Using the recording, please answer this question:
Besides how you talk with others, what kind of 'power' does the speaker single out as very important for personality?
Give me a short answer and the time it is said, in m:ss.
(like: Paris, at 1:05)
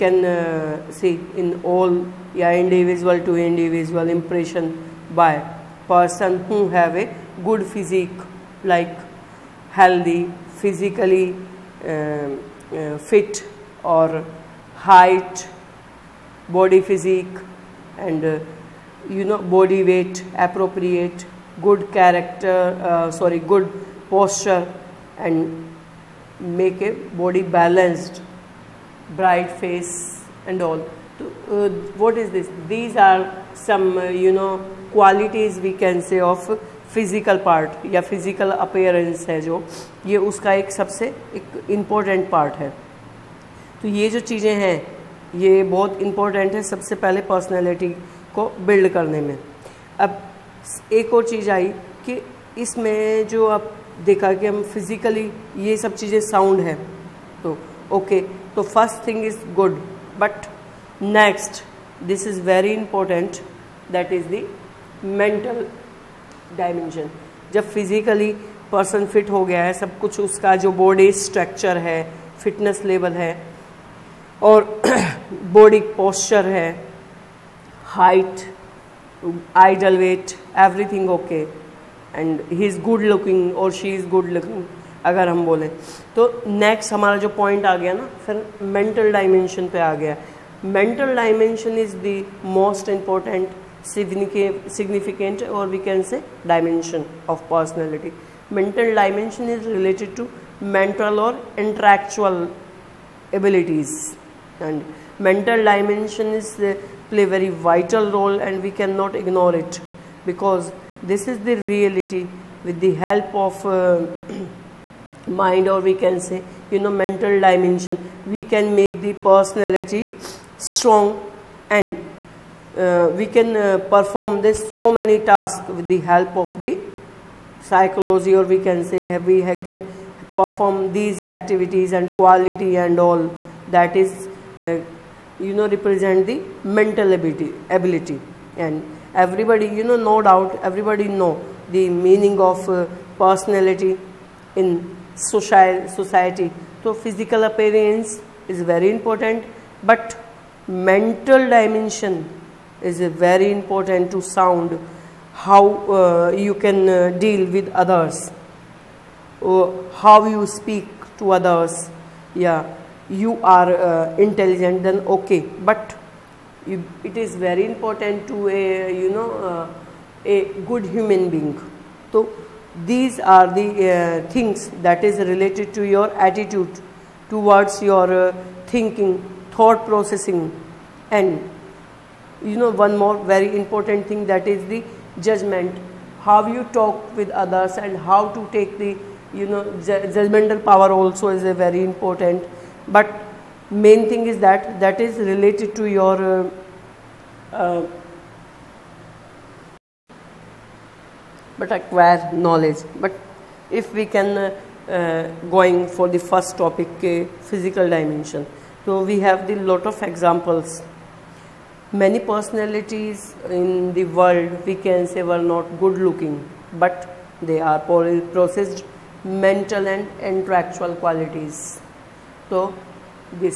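judgmental power, at 3:10.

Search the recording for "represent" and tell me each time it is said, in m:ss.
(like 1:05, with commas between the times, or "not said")
2:15.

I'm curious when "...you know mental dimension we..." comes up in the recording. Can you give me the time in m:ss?
1:56.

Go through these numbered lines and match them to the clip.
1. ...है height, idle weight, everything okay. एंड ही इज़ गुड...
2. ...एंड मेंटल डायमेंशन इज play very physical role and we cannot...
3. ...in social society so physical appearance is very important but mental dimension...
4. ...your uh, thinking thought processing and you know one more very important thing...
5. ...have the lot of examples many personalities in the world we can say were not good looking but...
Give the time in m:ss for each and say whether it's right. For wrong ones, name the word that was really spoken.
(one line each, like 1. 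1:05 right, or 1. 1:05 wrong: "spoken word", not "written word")
1. 1:16 right
2. 1:44 wrong: "vital", not "physical"
3. 2:24 right
4. 2:57 right
5. 3:29 right.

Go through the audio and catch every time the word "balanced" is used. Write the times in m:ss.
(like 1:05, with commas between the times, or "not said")
0:27.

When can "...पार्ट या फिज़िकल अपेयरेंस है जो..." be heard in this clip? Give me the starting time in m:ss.
0:37.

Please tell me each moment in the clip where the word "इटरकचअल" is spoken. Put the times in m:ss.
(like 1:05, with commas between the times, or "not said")
1:41.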